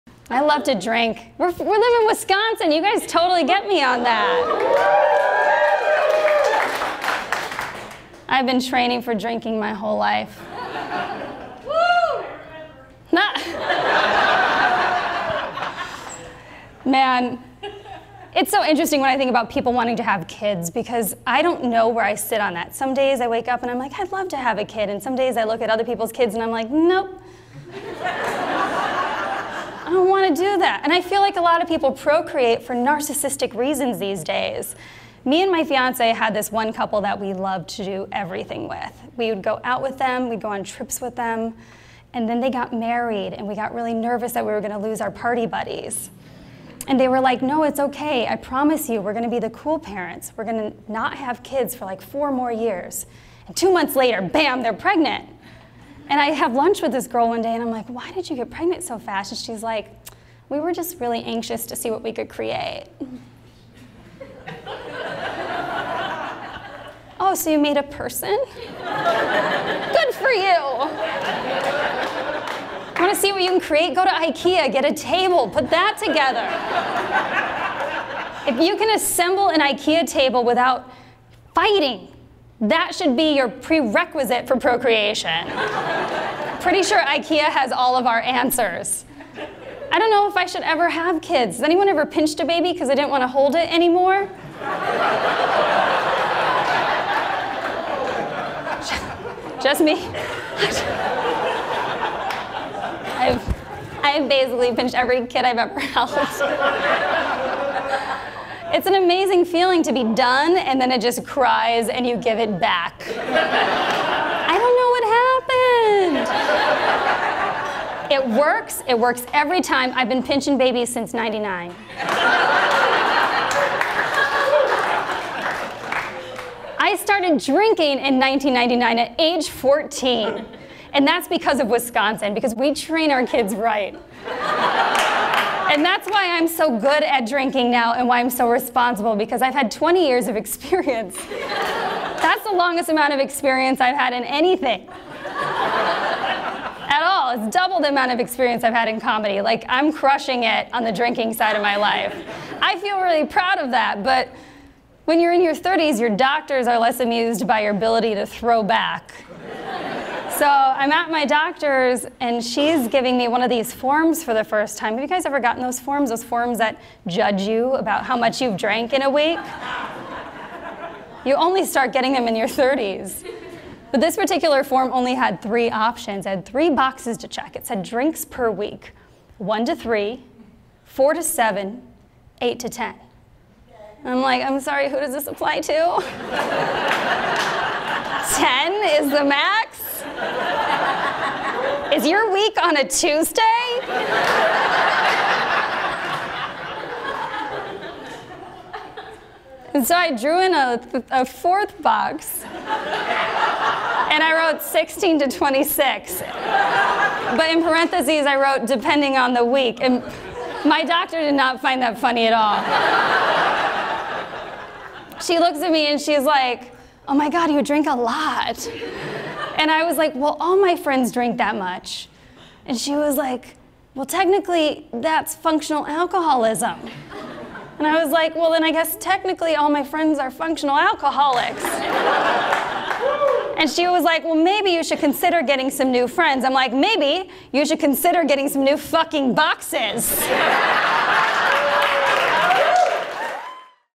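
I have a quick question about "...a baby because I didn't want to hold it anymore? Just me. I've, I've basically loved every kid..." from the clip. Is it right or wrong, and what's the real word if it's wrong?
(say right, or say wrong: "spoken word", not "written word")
wrong: "pinched", not "loved".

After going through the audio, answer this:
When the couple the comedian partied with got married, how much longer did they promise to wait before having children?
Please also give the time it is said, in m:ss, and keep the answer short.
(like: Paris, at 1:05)
4 more years, at 0:52.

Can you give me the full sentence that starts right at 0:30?
And I feel like a lot of people procreate for narcissistic reasons these days.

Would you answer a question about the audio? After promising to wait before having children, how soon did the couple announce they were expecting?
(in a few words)
2 months later.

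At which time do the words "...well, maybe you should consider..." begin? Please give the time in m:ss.
3:54.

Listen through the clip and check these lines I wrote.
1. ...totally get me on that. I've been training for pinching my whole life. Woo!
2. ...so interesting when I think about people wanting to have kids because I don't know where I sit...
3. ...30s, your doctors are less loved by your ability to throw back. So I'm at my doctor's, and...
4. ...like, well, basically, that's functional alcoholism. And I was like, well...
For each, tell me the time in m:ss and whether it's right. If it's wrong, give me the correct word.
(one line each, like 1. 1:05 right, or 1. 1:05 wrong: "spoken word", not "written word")
1. 0:03 wrong: "drinking", not "pinching"
2. 0:18 right
3. 2:35 wrong: "amused", not "loved"
4. 3:43 wrong: "technically", not "basically".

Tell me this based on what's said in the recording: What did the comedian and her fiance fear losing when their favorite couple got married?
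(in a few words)
party buddies.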